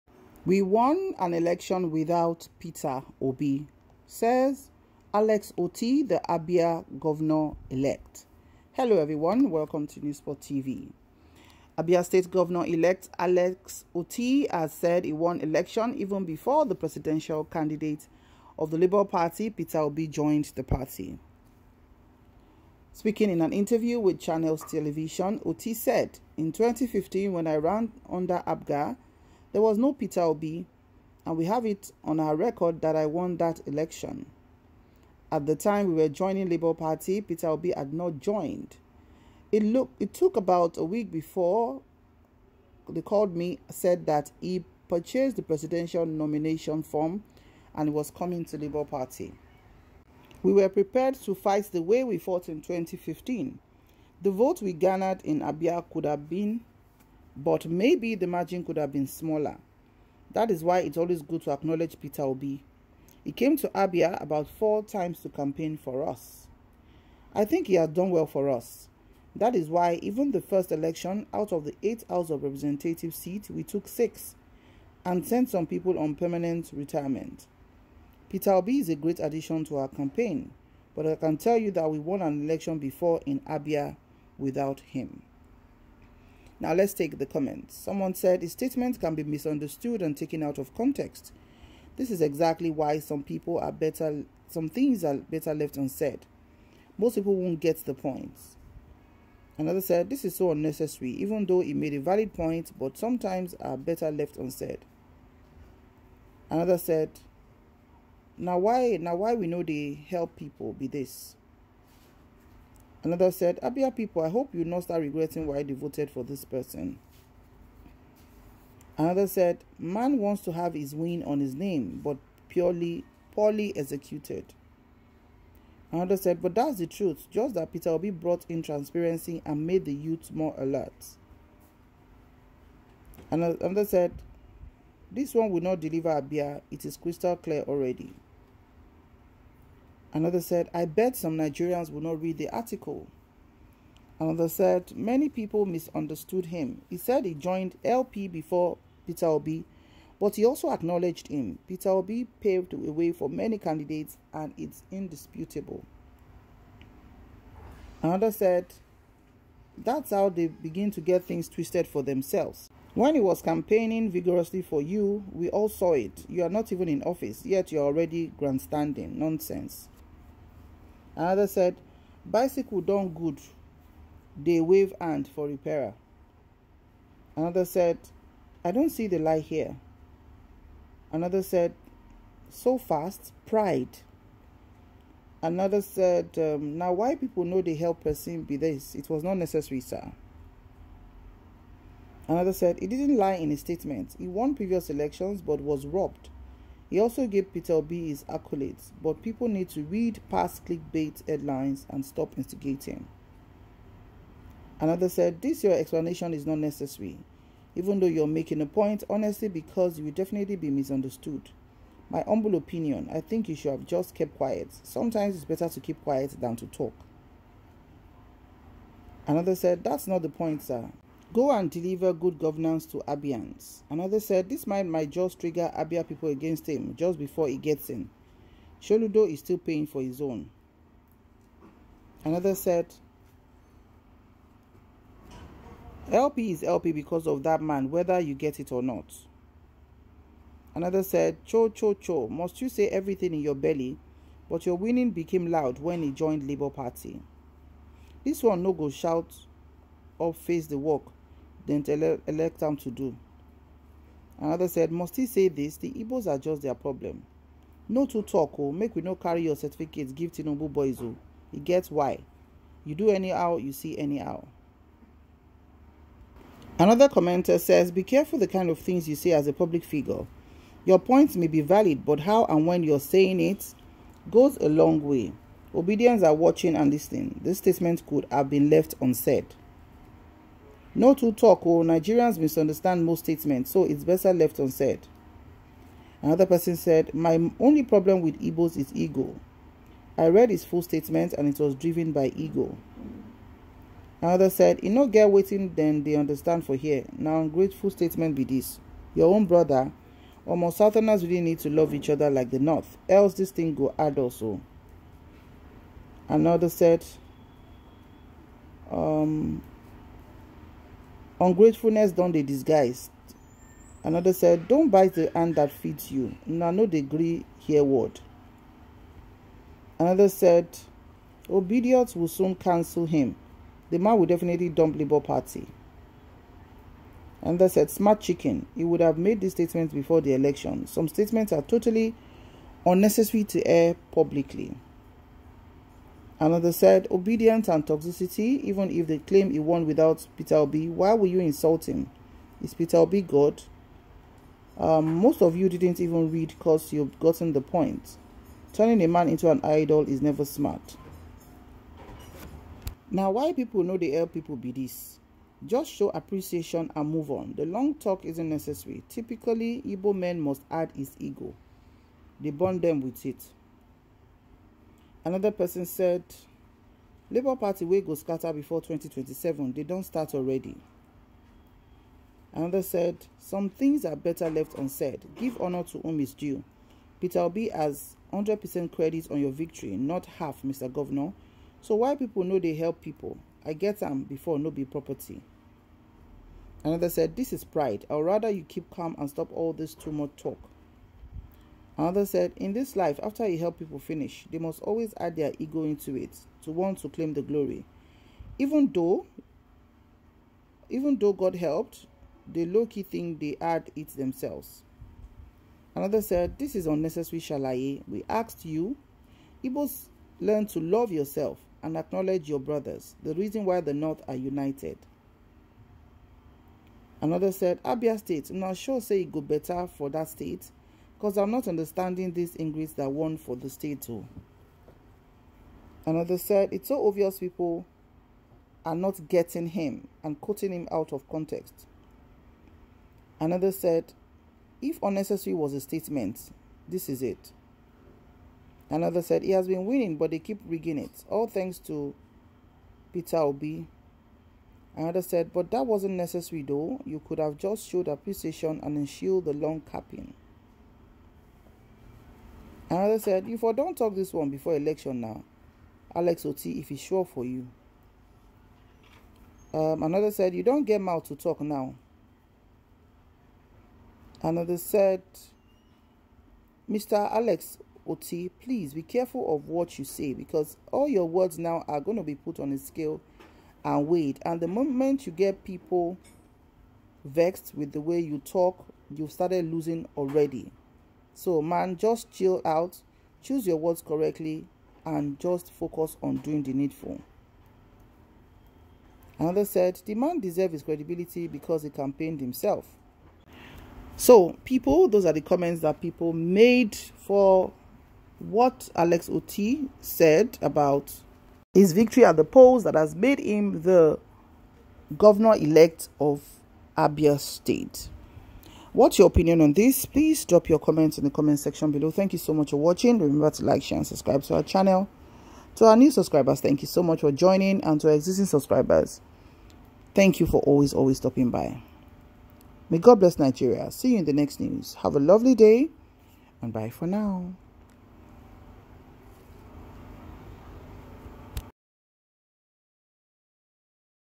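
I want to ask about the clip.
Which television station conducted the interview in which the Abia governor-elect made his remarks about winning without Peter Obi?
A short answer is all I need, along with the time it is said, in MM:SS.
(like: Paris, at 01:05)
Channels Television, at 00:24.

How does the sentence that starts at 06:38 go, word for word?
Even though even though God helped, they low-key think they add it themselves.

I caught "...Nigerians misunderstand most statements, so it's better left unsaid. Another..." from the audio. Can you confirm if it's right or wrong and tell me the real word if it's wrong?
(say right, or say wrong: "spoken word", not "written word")
right.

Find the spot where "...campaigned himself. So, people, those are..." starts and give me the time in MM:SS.
08:11.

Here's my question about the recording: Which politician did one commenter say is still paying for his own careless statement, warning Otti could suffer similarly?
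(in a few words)
Soludo.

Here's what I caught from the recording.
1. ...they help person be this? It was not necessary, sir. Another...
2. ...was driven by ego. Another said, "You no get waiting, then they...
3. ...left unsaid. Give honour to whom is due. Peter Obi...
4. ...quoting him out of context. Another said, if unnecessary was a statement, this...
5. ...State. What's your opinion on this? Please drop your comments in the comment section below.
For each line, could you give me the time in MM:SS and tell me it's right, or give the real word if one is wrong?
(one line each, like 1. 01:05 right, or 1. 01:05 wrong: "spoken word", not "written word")
1. 03:07 right
2. 04:51 right
3. 06:14 right
4. 07:10 right
5. 08:27 right.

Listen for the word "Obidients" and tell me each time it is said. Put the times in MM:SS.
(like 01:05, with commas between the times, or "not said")
04:35, 05:21, 05:37.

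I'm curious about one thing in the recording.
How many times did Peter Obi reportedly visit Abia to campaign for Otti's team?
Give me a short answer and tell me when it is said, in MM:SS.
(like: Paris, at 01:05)
4, at 01:04.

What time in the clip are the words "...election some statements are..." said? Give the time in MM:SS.
05:30.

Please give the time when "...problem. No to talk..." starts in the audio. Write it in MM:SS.
04:16.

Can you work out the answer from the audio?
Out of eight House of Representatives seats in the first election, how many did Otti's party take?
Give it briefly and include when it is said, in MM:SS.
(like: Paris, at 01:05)
6, at 01:13.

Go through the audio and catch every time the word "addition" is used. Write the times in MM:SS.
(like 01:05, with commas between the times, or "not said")
01:19.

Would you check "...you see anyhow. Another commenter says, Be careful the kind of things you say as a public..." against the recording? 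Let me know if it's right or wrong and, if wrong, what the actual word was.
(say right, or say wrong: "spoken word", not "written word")
right.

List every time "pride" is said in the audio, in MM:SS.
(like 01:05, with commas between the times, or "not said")
03:03, 06:27.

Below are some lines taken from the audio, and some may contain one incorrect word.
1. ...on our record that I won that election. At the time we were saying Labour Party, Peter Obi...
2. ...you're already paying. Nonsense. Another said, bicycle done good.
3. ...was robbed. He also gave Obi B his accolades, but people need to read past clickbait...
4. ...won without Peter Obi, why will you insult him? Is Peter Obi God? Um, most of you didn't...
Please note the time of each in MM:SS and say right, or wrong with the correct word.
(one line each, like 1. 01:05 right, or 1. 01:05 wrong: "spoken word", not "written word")
1. 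00:32 wrong: "joining", not "saying"
2. 02:47 wrong: "grandstanding", not "paying"
3. 03:15 wrong: "Peter", not "Obi"
4. 05:39 right.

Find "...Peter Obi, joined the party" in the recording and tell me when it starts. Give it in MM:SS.
00:19.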